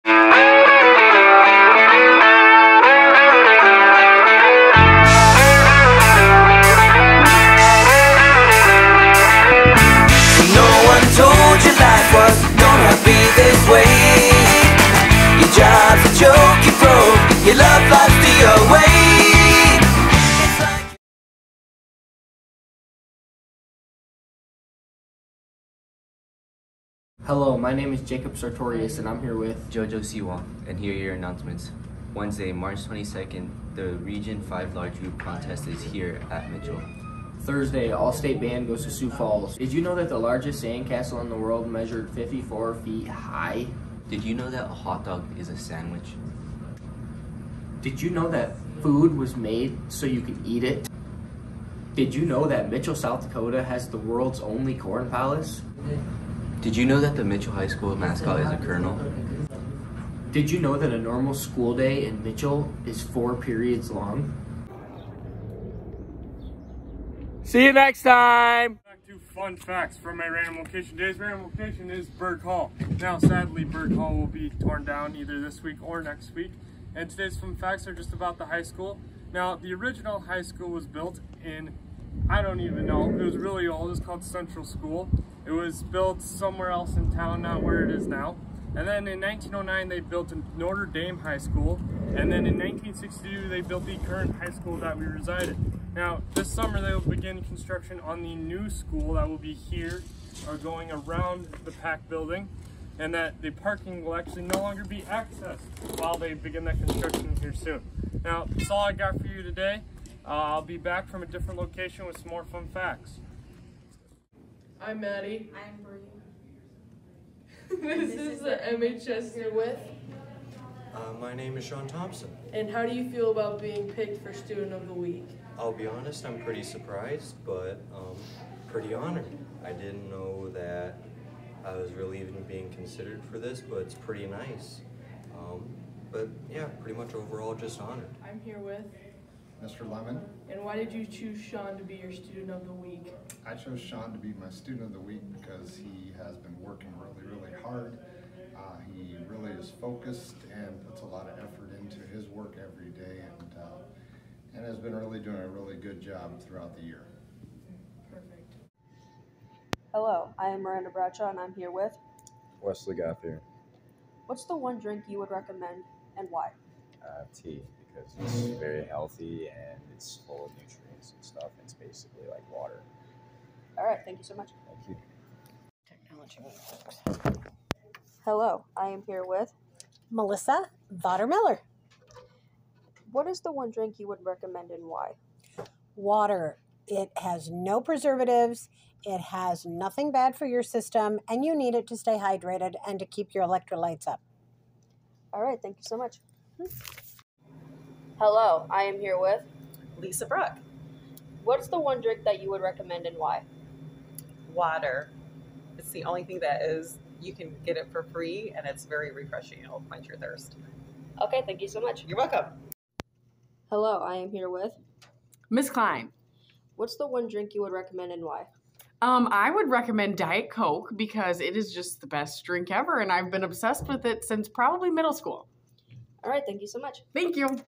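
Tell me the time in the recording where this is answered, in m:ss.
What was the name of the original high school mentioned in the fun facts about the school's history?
1:24.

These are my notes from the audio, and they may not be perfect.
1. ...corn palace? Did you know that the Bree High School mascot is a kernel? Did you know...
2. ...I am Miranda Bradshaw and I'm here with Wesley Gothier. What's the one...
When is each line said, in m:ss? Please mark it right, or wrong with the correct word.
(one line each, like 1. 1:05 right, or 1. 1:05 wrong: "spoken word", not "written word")
1. 0:54 wrong: "Mitchell", not "Bree"
2. 2:40 right.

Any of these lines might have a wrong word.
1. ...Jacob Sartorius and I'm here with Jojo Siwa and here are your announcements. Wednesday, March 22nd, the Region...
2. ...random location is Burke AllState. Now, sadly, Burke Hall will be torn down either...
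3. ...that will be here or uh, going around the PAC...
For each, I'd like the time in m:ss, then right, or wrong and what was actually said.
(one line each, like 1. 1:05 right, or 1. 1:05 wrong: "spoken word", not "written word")
1. 0:28 right
2. 1:11 wrong: "Hall", not "AllState"
3. 1:39 right.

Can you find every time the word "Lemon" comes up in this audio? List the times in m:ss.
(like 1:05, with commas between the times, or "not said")
2:19.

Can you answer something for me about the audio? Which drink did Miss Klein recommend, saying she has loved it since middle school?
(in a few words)
Diet Coke.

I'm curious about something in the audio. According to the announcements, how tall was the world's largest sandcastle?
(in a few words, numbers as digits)
54 feet.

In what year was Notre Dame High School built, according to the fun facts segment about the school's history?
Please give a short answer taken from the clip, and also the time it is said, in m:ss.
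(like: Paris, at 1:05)
1909, at 1:29.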